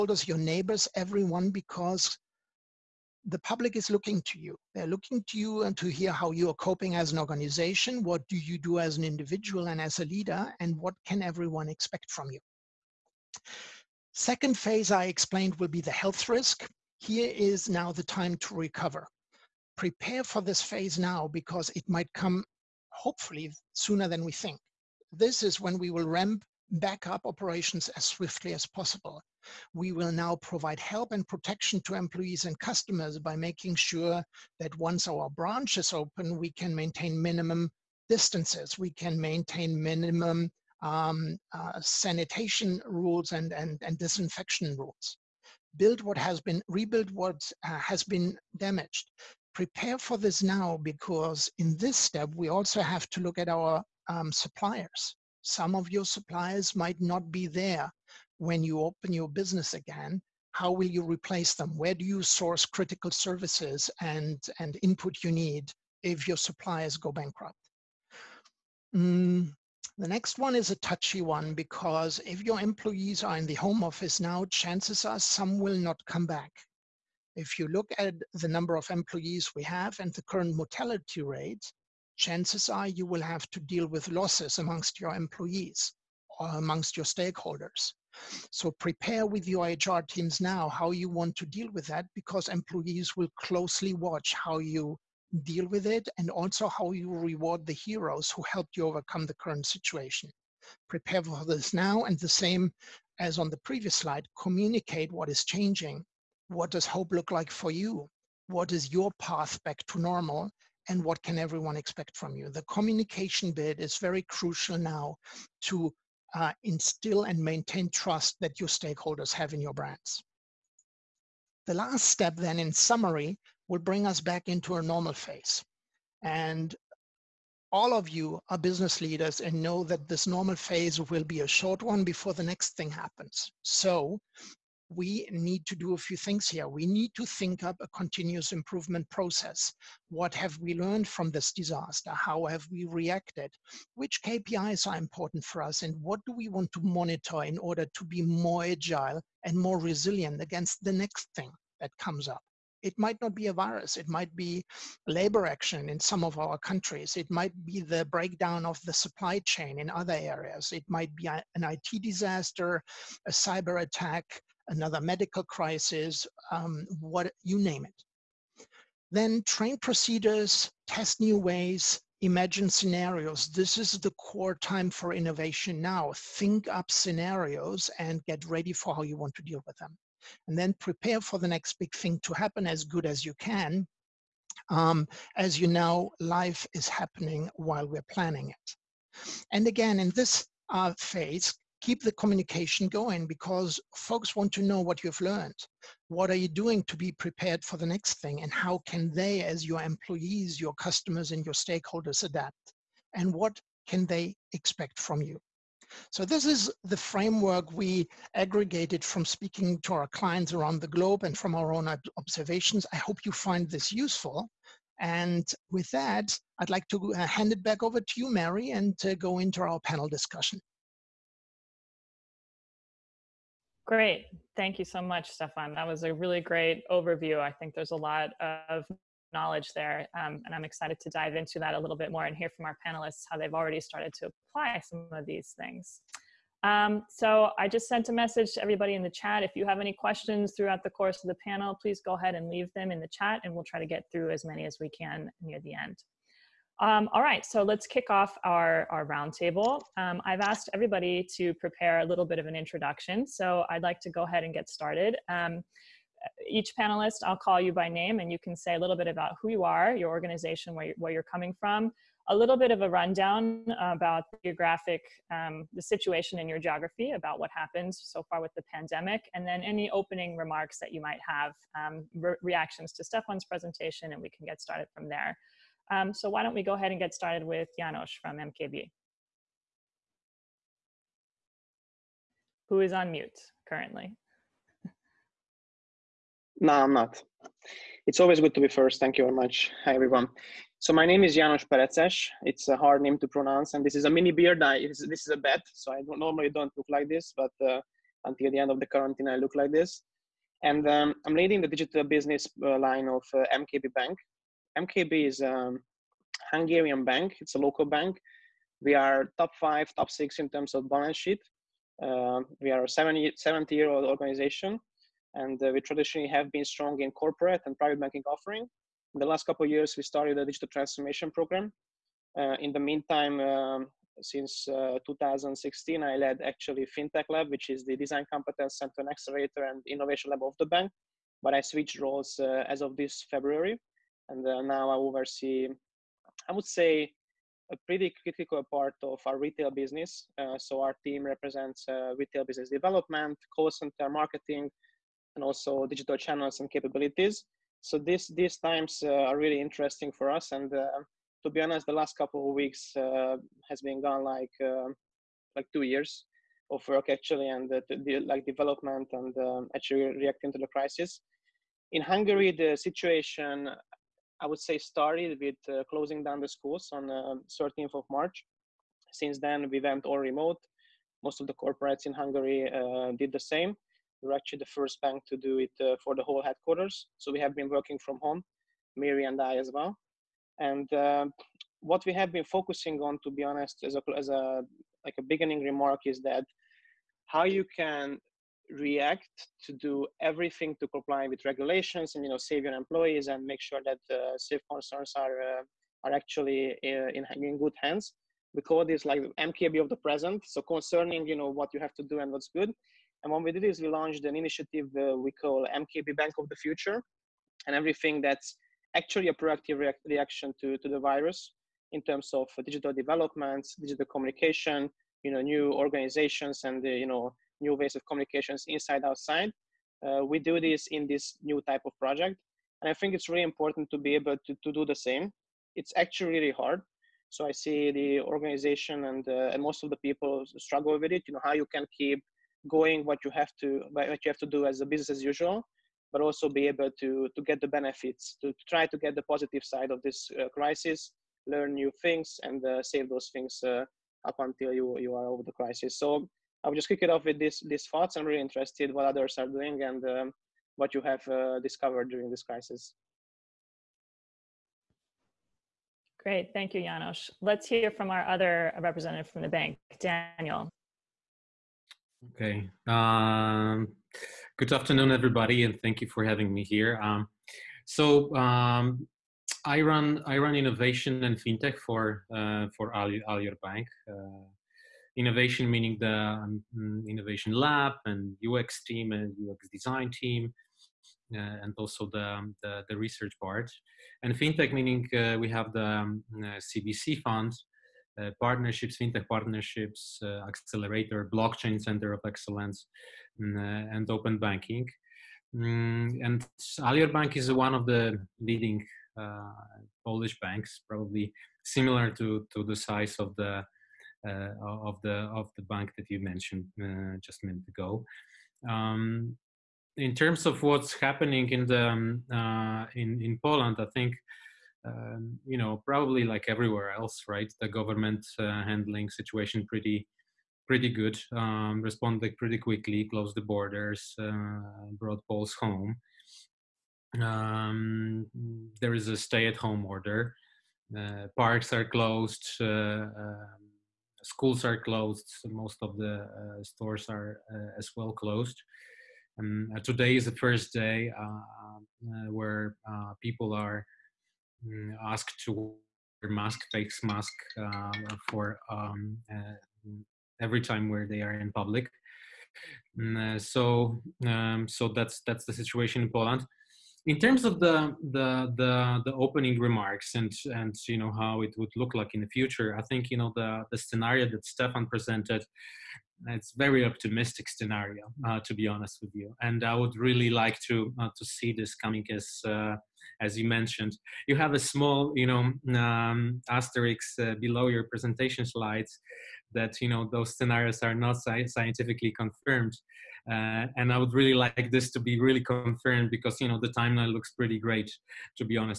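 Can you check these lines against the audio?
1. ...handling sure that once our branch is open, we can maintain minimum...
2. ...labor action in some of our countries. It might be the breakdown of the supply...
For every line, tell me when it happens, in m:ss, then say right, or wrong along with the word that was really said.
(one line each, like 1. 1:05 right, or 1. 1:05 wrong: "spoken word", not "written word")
1. 0:33 wrong: "making", not "handling"
2. 2:35 right.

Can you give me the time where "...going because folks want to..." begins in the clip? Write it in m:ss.
3:12.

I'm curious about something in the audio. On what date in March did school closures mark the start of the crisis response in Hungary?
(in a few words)
13th of March.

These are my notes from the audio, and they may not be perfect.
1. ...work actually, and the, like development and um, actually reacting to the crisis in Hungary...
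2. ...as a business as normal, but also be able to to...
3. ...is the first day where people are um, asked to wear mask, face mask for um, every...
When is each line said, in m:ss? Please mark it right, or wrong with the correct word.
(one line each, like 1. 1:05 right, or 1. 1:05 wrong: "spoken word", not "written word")
1. 5:56 right
2. 7:14 wrong: "usual", not "normal"
3. 9:00 right.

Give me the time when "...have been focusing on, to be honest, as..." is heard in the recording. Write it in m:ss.
6:22.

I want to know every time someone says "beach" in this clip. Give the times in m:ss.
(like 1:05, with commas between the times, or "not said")
not said.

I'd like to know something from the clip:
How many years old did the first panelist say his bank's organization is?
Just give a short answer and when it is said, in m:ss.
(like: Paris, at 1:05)
70, at 5:12.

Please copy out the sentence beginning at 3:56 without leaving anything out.
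Um, so I just sent a message to everybody in the chat.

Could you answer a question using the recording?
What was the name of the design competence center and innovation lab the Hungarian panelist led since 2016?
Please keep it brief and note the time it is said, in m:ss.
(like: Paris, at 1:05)
FinTech Lab, at 5:26.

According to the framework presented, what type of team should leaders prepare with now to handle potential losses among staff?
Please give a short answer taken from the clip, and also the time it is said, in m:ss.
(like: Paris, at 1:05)
HR teams, at 1:29.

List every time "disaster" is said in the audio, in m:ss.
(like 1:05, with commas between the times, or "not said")
2:21, 2:42.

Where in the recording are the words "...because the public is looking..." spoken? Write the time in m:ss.
0:01.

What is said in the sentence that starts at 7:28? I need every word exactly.
I'm really interested what others are doing and um, what you have uh, discovered during this crisis.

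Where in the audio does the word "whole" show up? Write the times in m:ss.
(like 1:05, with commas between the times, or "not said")
6:16.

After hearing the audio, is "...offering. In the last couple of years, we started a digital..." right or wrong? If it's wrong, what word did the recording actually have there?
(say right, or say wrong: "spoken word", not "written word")
right.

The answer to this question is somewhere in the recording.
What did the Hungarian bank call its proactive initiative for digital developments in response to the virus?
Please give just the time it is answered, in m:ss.
6:45.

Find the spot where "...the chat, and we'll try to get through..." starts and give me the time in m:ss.
4:03.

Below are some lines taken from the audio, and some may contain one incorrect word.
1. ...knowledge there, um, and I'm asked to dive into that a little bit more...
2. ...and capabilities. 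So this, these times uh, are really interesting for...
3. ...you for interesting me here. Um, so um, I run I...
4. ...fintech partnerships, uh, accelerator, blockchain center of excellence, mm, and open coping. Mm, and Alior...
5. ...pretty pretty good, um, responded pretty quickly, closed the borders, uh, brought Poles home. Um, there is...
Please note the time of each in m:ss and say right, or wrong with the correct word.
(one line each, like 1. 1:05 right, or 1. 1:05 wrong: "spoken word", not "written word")
1. 3:49 wrong: "excited", not "asked"
2. 5:46 right
3. 7:46 wrong: "having", not "interesting"
4. 8:09 wrong: "banking", not "coping"
5. 8:39 right.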